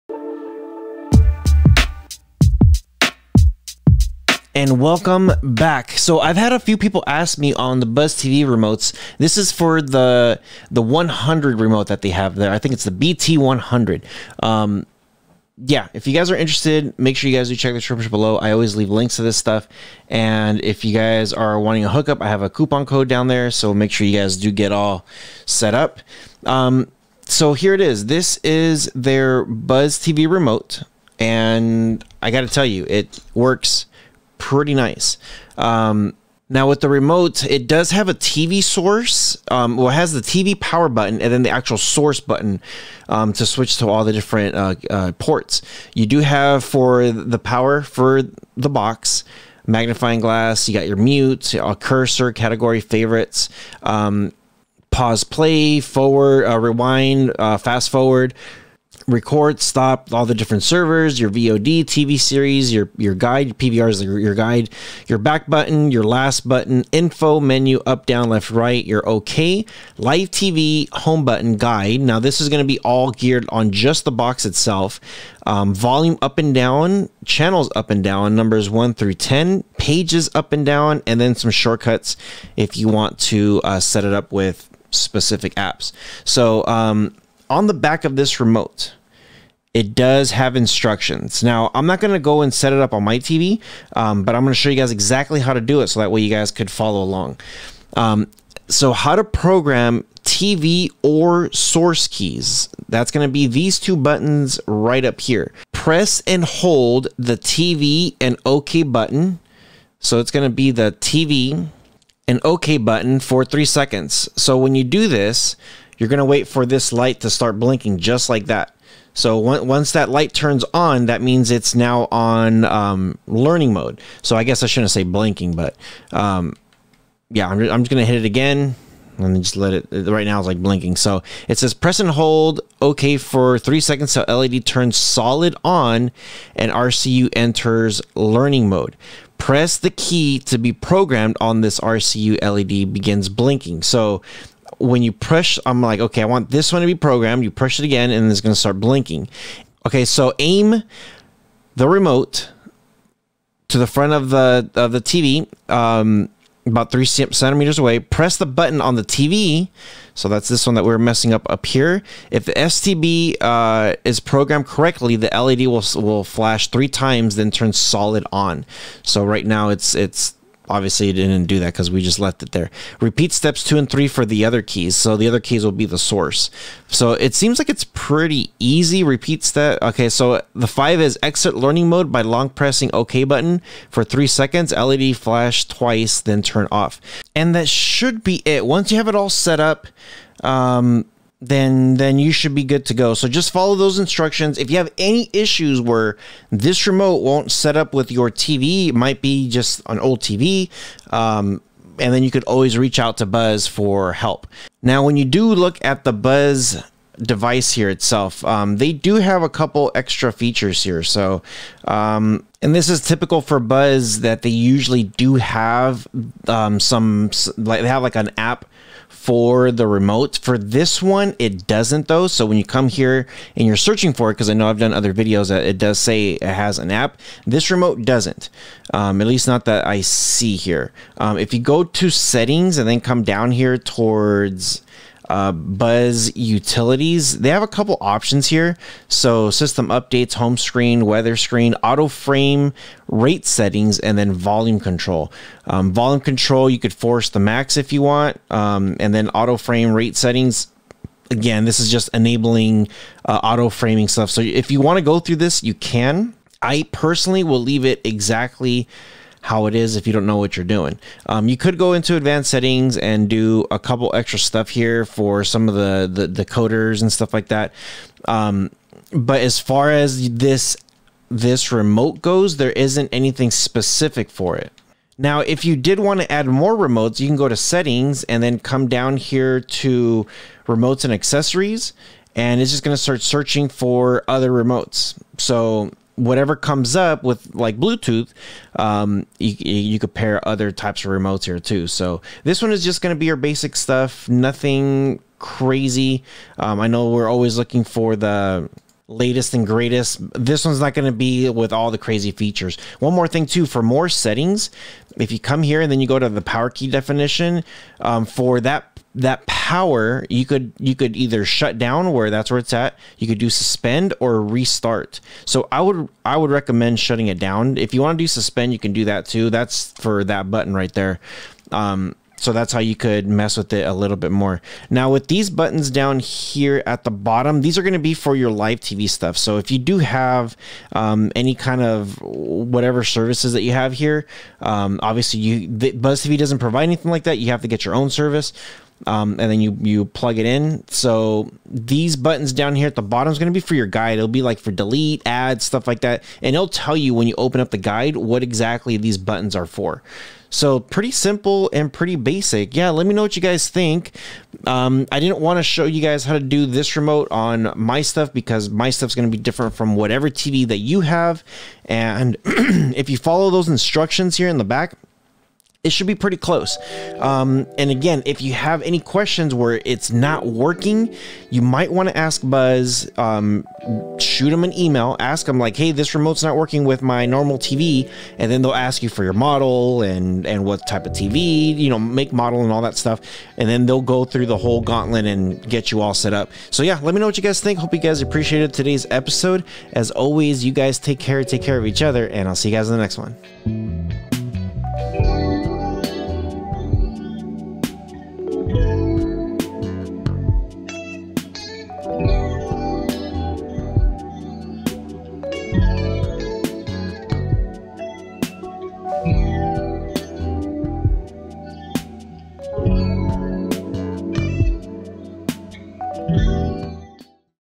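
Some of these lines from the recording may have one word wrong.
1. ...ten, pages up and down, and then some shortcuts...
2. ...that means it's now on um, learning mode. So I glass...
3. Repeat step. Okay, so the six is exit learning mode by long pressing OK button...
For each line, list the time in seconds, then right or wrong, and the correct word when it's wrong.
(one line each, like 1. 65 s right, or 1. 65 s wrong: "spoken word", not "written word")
1. 79 s right
2. 121 s wrong: "guess", not "glass"
3. 179 s wrong: "five", not "six".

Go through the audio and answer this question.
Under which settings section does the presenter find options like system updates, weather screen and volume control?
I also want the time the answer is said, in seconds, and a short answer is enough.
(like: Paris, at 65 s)
Buzz Utilities, at 235 s.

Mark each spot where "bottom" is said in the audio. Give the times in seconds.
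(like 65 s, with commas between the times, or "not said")
327 s, 343 s.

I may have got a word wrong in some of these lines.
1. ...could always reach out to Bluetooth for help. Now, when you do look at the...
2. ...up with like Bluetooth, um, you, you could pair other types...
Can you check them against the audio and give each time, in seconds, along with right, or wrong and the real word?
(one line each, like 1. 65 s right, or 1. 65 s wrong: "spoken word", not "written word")
1. 202 s wrong: "Buzz", not "Bluetooth"
2. 286 s right.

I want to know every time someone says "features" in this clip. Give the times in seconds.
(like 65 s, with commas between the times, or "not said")
210 s, 302 s.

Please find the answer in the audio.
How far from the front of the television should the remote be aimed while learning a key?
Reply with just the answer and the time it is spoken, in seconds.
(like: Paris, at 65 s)
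3 centimeters, at 156 s.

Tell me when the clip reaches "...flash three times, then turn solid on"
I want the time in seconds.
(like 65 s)
166 s.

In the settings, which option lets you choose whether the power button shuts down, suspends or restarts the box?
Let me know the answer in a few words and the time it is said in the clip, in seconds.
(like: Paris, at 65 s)
Power key definition, at 306 s.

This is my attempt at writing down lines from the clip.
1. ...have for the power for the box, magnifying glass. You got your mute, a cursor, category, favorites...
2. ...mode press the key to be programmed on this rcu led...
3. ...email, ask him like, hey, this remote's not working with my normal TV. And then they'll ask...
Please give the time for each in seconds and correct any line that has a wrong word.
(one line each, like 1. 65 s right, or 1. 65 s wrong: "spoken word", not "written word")
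1. 46 s right
2. 138 s right
3. 374 s right.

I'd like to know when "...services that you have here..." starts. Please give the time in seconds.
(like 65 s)
333 s.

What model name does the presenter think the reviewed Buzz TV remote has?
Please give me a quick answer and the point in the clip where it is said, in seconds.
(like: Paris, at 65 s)
BT 100, at 12 s.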